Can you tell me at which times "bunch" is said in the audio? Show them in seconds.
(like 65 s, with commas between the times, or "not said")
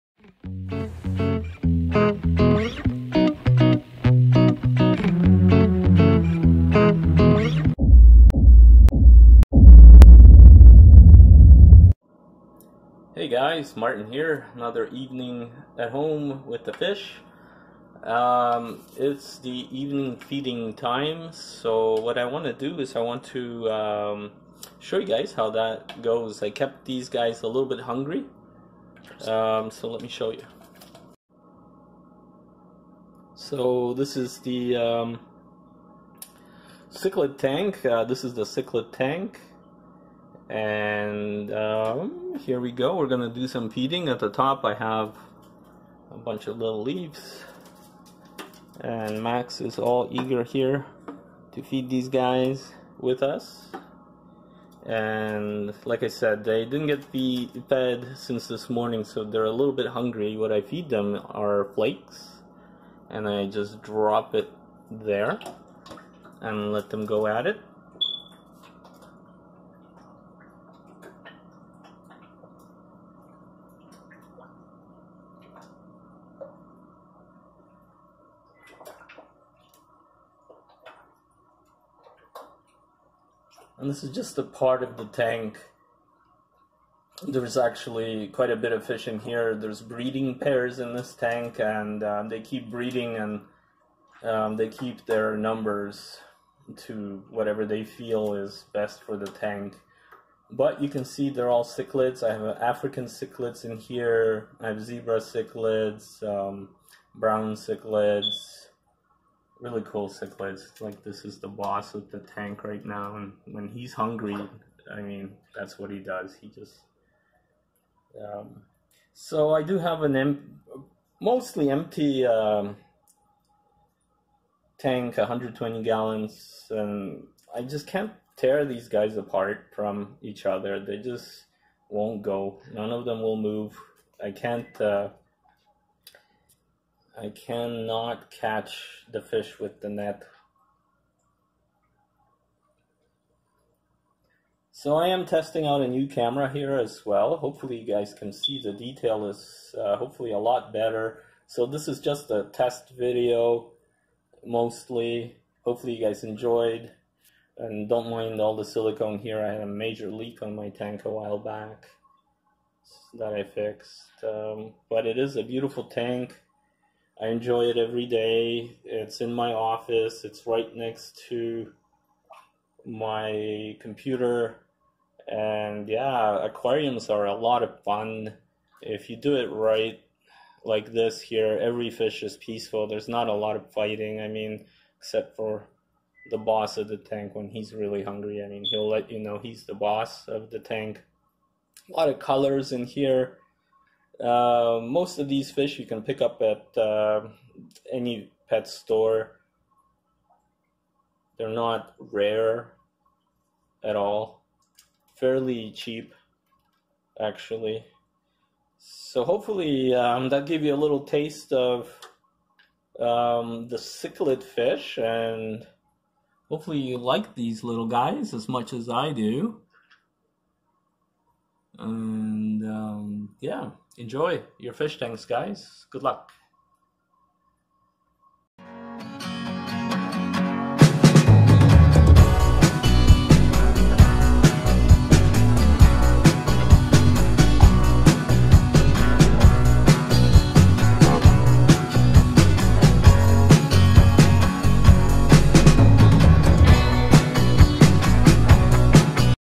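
46 s.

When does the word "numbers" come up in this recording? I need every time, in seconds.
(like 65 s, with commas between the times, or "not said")
95 s.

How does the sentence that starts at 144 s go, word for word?
So I am testing out a new camera here as well.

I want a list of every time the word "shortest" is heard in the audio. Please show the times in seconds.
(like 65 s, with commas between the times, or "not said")
not said.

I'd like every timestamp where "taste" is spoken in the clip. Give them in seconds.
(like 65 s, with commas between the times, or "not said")
211 s.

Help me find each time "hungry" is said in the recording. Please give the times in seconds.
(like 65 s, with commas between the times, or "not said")
27 s, 59 s, 113 s, 188 s.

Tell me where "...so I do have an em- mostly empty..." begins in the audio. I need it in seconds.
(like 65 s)
119 s.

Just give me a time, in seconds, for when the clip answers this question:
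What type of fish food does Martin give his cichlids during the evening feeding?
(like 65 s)
61 s.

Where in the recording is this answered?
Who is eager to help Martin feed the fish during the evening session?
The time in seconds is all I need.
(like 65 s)
49 s.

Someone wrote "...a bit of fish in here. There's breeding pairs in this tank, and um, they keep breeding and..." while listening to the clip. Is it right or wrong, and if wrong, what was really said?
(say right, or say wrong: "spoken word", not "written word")
right.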